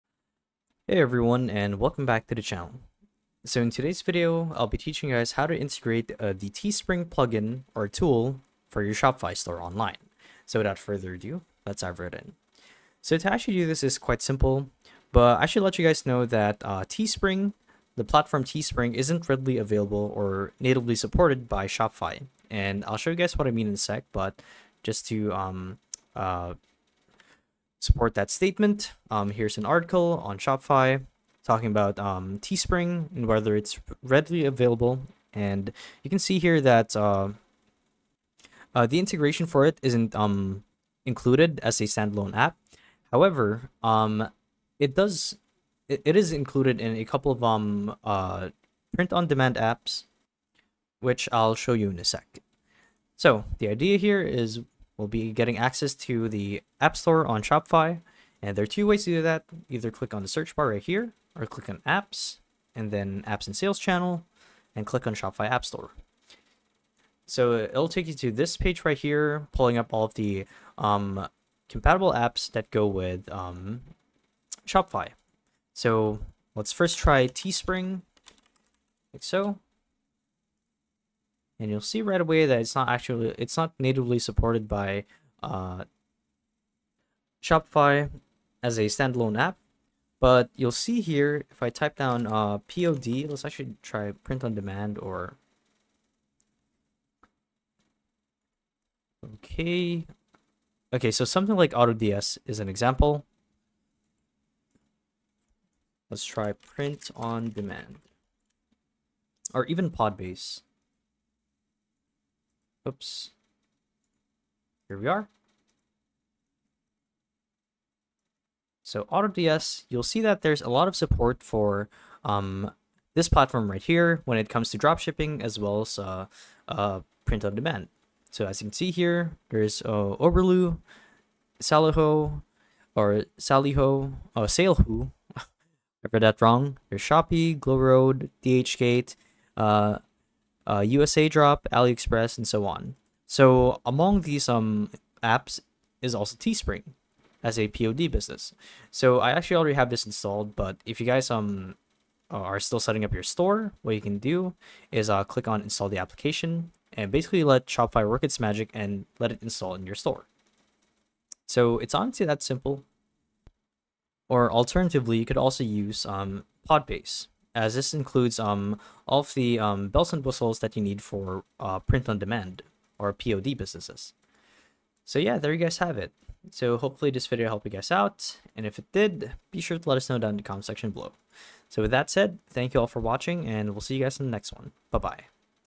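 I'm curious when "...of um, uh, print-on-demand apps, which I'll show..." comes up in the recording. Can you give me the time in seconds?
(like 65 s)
47 s.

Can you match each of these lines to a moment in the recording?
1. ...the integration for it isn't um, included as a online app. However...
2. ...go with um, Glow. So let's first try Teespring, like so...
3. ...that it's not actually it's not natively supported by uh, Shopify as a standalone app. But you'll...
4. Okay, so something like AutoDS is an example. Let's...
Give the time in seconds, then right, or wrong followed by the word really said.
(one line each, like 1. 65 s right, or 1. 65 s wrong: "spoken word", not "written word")
1. 38 s wrong: "standalone", not "online"
2. 72 s wrong: "Shopify", not "Glow"
3. 82 s right
4. 100 s right.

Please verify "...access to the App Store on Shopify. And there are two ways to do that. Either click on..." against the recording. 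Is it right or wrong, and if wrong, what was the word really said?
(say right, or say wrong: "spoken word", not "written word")
right.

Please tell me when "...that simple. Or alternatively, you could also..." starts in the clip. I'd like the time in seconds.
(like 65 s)
162 s.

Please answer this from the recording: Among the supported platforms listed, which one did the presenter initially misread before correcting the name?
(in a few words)
SaleHoo.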